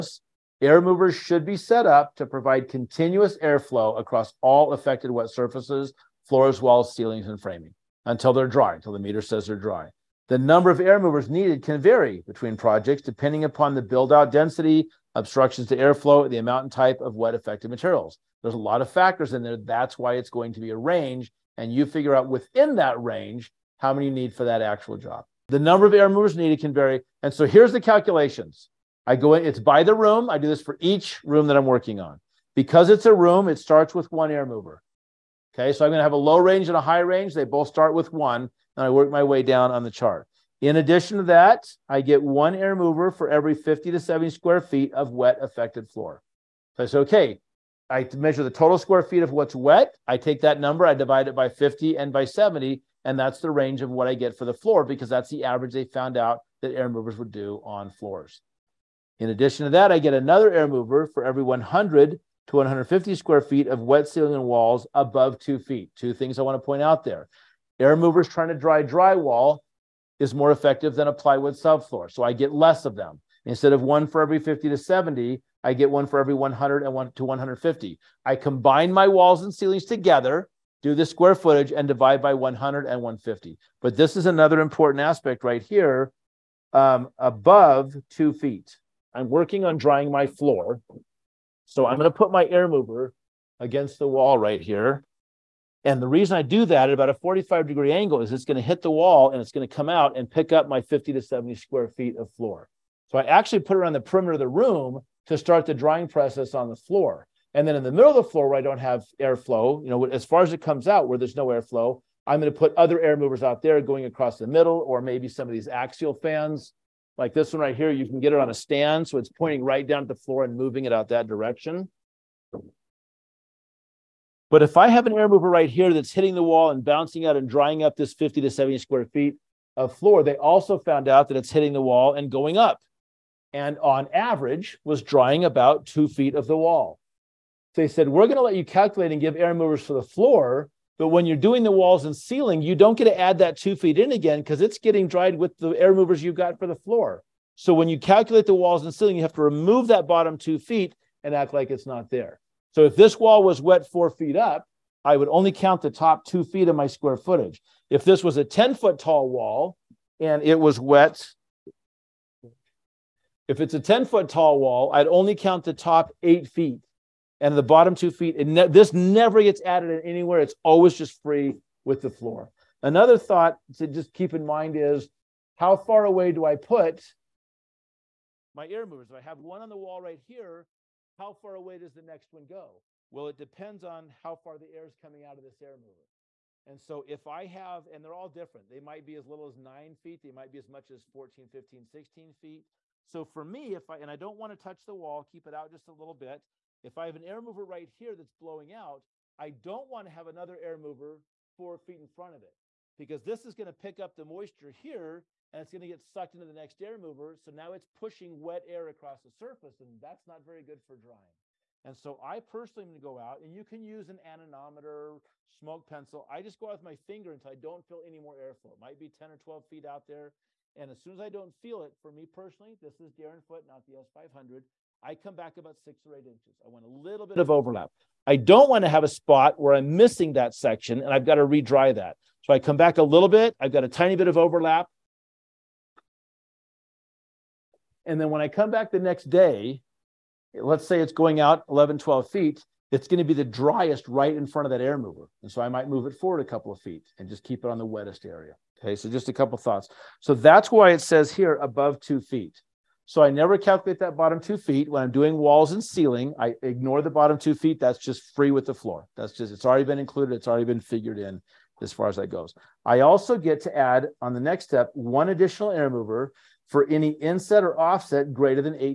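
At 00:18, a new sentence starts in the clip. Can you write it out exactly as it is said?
There's a lot of factors in there.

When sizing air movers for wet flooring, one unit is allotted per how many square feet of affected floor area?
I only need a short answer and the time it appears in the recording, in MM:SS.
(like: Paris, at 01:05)
50 to 70, at 00:42.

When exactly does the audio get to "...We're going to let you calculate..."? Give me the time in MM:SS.
02:18.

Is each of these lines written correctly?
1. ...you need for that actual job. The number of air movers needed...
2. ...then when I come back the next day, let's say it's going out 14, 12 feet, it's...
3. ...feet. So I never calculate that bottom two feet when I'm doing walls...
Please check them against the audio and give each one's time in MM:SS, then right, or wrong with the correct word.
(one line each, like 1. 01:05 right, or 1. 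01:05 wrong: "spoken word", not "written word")
1. 00:24 right
2. 03:58 wrong: "11", not "14"
3. 04:12 right.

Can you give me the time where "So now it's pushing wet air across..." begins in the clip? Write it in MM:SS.
03:27.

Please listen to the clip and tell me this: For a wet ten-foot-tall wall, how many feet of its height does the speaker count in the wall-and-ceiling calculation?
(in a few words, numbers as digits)
8 feet.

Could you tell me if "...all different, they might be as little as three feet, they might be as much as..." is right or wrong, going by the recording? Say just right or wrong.
wrong.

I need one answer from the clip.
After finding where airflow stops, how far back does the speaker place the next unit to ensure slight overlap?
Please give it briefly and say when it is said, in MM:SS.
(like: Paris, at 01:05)
6 or 8 inches, at 03:45.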